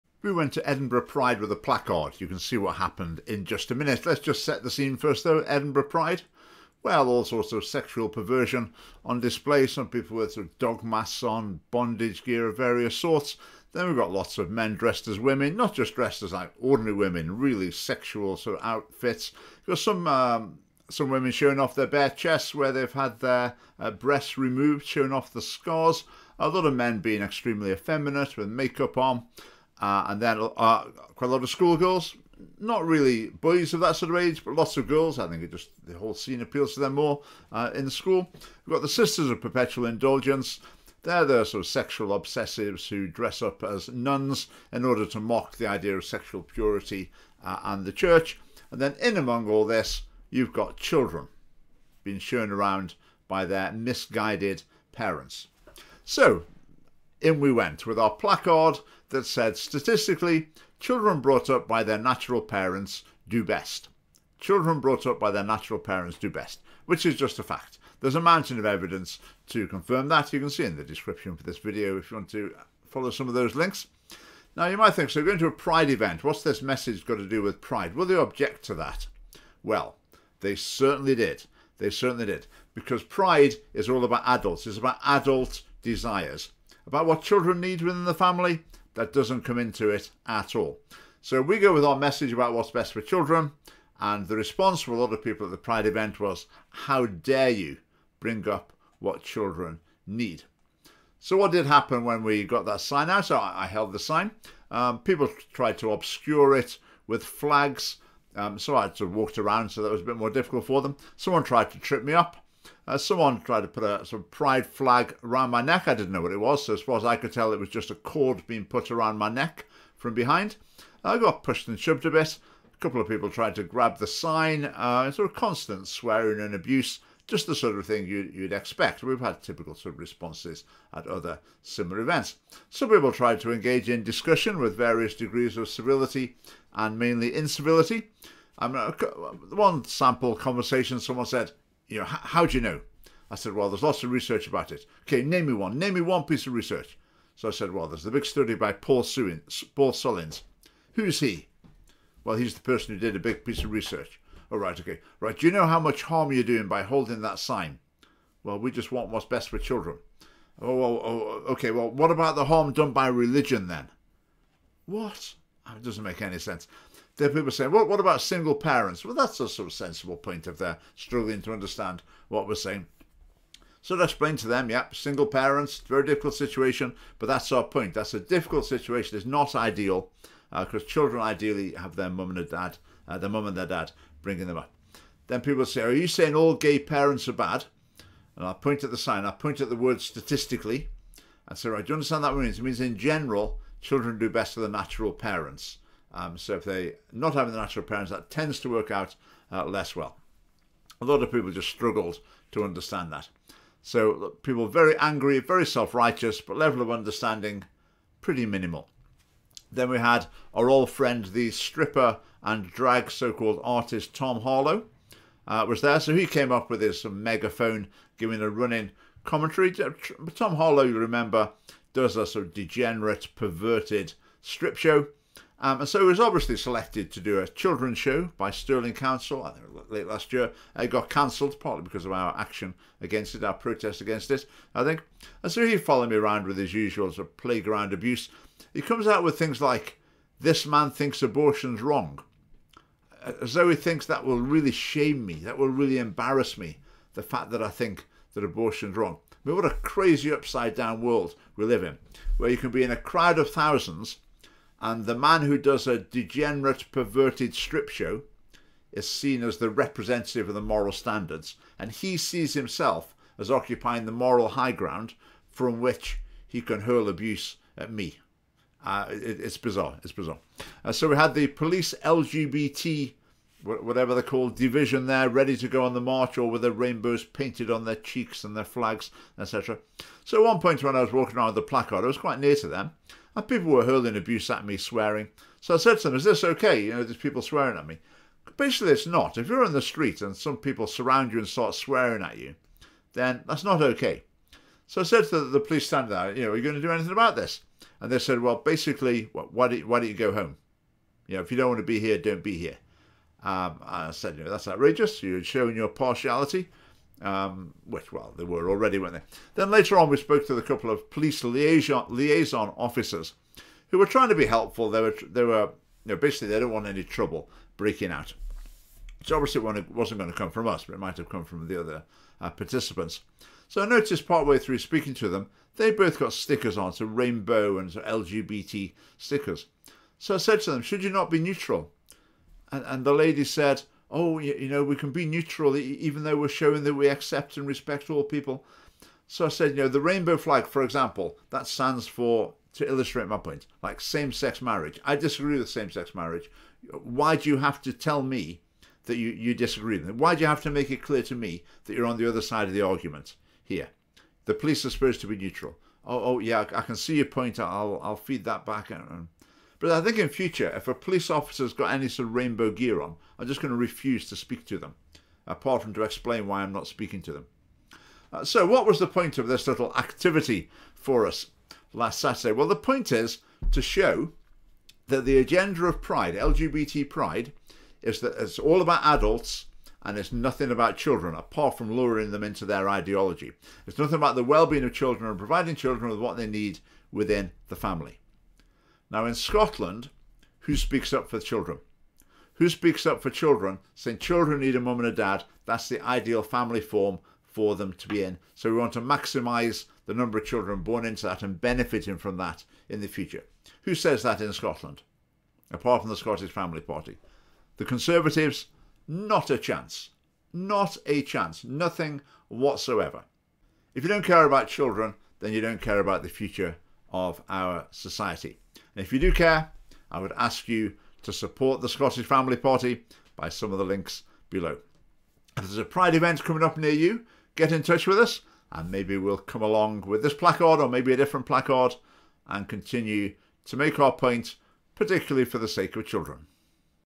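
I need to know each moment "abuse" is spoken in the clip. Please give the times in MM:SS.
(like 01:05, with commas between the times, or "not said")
02:06, 03:57, 04:27, 04:44.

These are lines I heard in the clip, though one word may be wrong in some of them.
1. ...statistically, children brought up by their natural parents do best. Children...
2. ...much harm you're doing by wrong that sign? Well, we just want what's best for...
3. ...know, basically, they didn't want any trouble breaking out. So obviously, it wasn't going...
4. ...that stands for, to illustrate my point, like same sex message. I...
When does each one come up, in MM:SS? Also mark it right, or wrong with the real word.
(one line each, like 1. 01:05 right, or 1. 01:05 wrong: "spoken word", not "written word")
1. 00:59 right
2. 02:35 wrong: "holding", not "wrong"
3. 05:16 right
4. 05:41 wrong: "marriage", not "message".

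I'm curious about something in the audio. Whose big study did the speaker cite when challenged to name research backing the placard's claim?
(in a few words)
Paul Sullins.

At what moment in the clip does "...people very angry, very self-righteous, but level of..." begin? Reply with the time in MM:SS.
03:24.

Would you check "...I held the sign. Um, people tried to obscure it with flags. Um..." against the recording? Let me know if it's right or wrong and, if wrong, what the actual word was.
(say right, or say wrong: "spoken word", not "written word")
right.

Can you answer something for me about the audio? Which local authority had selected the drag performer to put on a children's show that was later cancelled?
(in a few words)
Stirling Council.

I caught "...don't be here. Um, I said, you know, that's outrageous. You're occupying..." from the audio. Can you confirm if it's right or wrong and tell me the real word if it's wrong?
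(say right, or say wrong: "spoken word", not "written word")
wrong: "showing", not "occupying".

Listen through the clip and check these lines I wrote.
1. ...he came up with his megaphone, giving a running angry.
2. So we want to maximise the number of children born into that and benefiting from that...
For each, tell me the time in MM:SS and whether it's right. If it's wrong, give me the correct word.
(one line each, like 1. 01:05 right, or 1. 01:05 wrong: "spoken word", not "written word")
1. 03:36 wrong: "commentary", not "angry"
2. 06:38 right.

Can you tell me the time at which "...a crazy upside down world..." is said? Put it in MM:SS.
04:09.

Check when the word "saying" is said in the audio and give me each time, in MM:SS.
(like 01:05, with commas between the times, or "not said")
02:47, 02:52, 03:06, 06:33.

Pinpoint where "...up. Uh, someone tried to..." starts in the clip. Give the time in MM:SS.
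01:52.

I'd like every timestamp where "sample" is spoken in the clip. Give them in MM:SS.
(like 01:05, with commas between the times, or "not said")
02:19.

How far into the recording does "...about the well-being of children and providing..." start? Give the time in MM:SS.
06:24.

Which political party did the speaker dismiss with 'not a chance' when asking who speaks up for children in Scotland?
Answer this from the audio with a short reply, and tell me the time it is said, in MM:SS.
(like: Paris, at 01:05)
The Conservatives, at 06:47.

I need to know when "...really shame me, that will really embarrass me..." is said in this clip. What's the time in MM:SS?
04:04.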